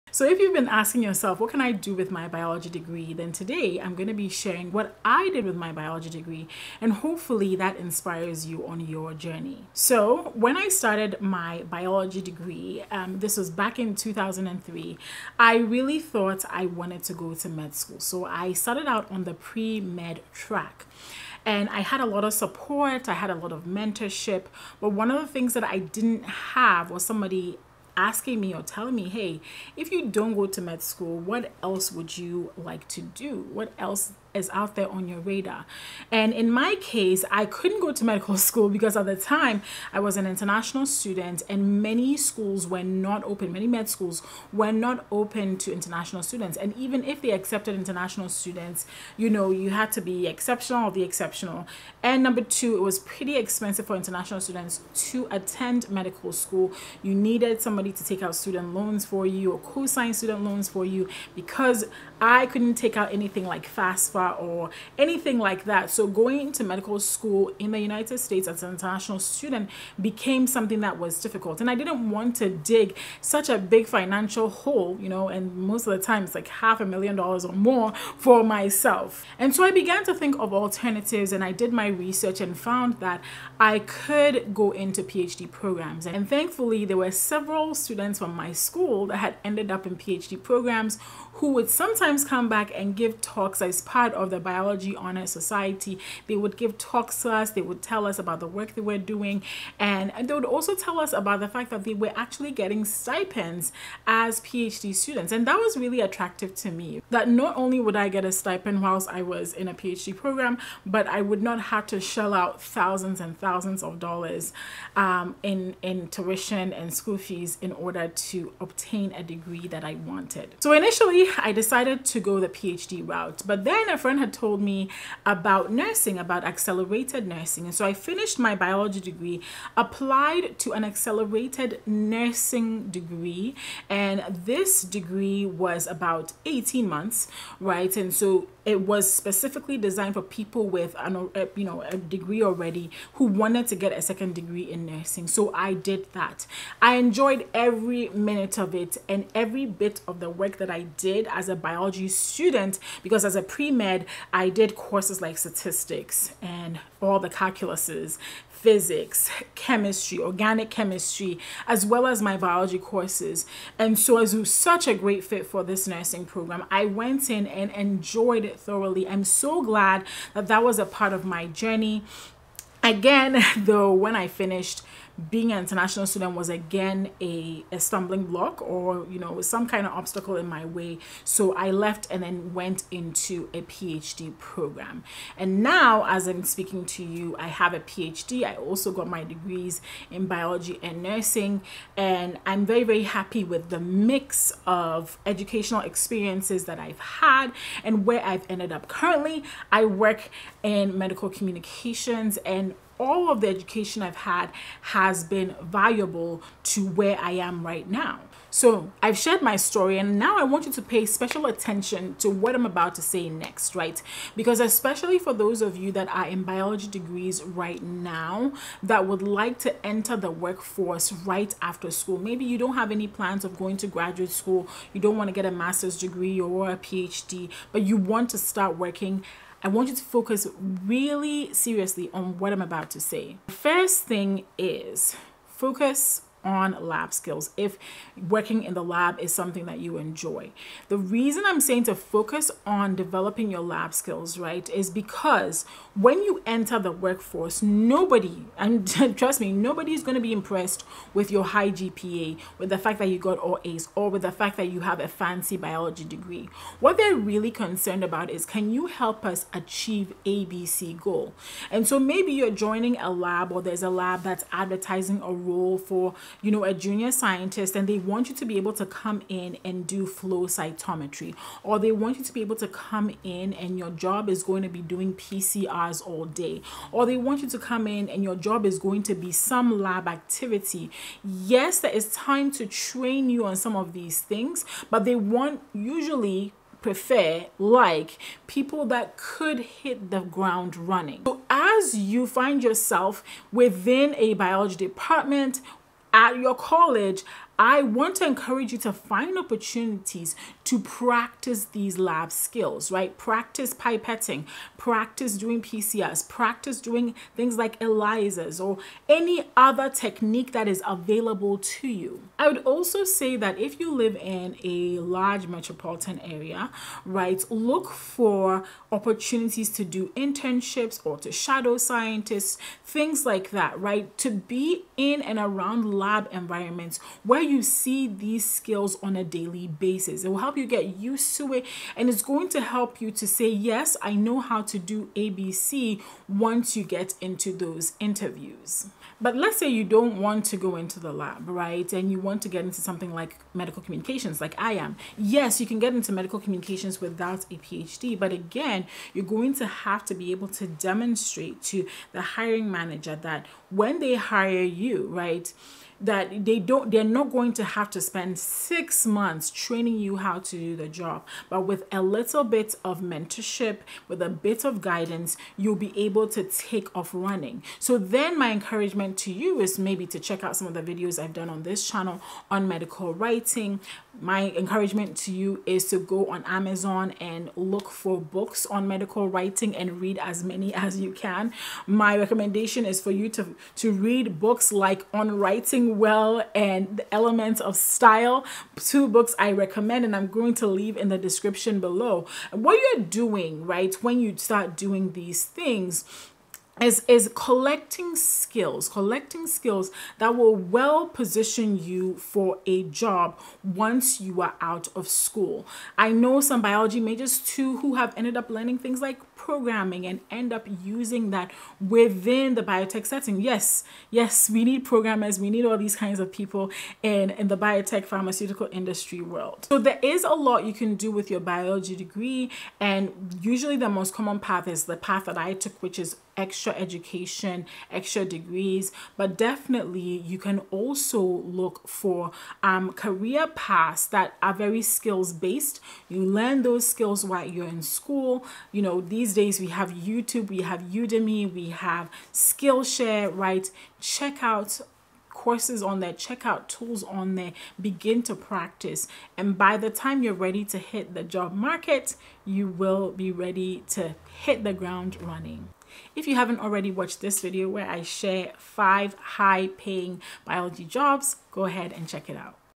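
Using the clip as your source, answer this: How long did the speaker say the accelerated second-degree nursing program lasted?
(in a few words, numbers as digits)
18 months.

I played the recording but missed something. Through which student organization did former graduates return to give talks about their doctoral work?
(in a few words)
Biology Honor Society.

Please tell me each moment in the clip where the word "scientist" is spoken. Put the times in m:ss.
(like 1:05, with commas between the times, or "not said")
4:27, 5:21.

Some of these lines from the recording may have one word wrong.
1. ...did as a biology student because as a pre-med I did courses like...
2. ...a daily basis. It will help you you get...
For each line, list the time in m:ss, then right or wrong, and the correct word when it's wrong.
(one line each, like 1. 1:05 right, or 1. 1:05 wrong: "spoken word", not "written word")
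1. 2:30 right
2. 5:29 right.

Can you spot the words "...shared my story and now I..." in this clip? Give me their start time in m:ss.
3:29.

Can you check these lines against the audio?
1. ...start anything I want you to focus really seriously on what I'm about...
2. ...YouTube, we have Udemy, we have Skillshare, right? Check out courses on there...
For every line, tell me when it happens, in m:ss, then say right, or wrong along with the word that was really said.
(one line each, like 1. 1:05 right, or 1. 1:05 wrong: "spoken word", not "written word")
1. 3:48 wrong: "working", not "anything"
2. 7:19 right.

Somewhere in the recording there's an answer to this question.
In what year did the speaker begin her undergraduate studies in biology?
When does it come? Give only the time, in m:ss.
0:13.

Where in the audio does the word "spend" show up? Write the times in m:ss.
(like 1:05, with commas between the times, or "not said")
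5:58.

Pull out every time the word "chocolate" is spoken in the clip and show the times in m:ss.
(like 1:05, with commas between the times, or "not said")
not said.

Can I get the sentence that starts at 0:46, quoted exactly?
And even if they accepted international students, you know, you had to be exceptional or the exceptional.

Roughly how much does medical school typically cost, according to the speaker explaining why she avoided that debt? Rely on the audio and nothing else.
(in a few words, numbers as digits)
half a million dollars.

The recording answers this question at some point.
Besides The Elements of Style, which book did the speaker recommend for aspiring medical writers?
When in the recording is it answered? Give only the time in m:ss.
6:25.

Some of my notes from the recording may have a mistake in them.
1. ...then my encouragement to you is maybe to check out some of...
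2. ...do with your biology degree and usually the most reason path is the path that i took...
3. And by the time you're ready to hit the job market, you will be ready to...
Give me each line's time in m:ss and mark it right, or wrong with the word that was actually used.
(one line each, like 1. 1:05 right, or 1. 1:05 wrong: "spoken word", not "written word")
1. 6:07 right
2. 7:00 wrong: "common", not "reason"
3. 7:29 right.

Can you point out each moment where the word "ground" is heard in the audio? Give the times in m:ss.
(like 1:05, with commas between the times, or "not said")
4:50, 7:34.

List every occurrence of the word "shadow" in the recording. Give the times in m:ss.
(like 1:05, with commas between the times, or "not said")
5:21.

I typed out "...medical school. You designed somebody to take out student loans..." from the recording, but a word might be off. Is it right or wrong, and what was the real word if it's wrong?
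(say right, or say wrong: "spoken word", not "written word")
wrong: "needed", not "designed".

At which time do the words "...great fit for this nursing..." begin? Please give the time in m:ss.
2:44.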